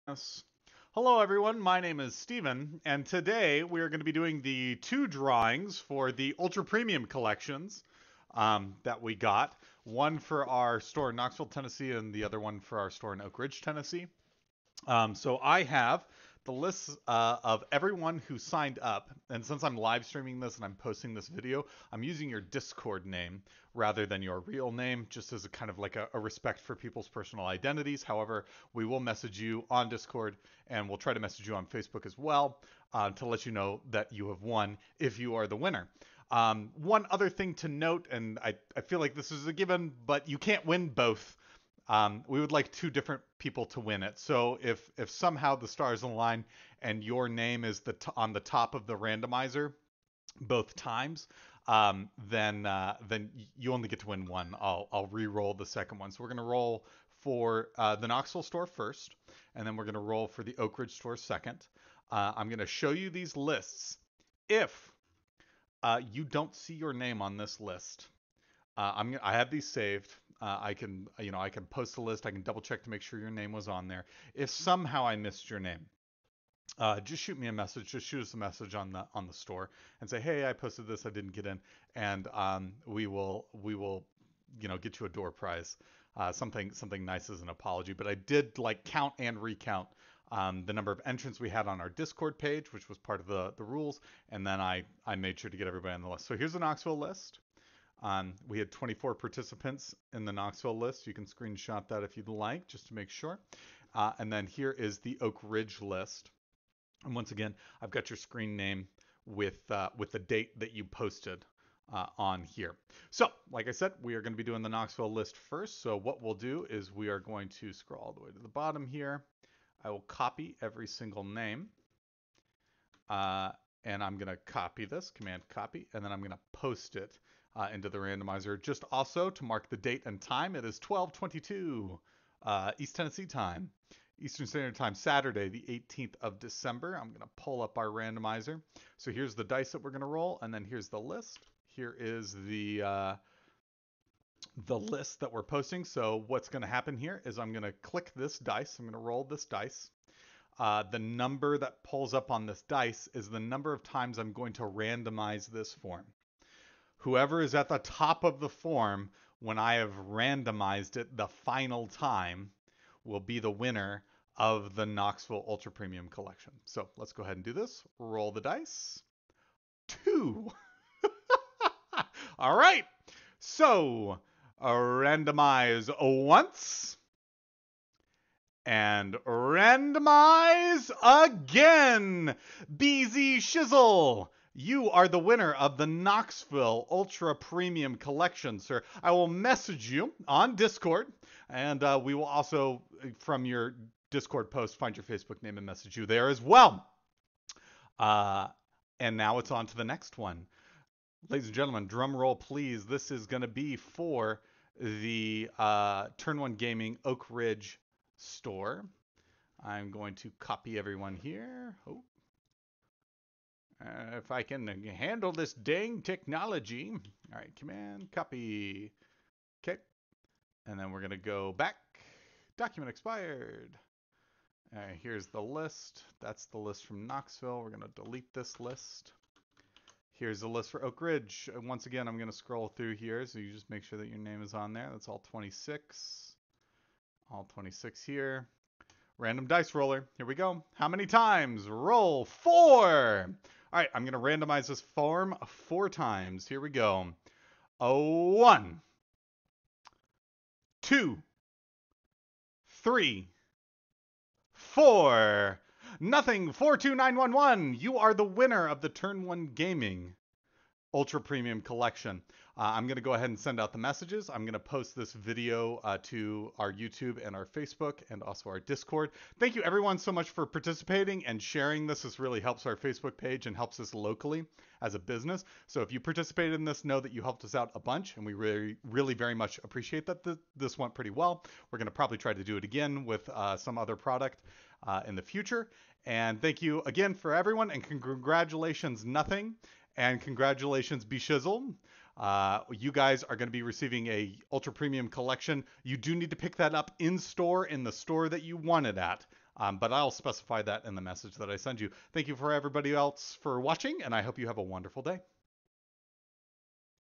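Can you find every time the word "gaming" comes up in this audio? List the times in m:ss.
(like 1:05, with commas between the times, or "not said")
3:26, 4:19.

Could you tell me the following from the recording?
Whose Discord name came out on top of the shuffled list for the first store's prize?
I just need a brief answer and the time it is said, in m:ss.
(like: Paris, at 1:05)
BZ Shizzle, at 3:02.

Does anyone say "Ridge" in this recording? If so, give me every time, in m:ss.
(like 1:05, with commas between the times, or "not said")
0:13, 1:00, 1:45, 3:27, 3:51.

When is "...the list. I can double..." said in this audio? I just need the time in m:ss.
1:11.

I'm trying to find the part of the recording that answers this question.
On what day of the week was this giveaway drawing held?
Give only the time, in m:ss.
2:14.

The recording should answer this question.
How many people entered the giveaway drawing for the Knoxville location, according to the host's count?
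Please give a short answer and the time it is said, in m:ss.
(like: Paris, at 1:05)
24, at 1:38.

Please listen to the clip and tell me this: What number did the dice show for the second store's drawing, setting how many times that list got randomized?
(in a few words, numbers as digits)
4.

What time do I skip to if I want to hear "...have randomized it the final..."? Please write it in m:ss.
2:39.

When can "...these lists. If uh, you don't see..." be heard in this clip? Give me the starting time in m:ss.
1:03.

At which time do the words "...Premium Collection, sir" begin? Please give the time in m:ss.
3:07.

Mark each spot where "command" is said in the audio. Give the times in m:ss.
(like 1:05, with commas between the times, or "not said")
2:05, 3:37.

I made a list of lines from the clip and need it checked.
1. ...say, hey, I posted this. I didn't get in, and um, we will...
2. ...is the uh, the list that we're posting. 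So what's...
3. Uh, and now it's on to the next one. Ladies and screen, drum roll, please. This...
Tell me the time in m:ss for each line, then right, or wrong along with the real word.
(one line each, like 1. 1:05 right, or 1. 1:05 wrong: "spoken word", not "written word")
1. 1:20 right
2. 2:21 right
3. 3:17 wrong: "gentlemen", not "screen".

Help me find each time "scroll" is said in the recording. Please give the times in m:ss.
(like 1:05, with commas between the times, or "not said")
1:57, 3:52.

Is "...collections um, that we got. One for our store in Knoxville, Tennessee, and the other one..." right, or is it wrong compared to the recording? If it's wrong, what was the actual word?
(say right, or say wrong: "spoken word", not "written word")
right.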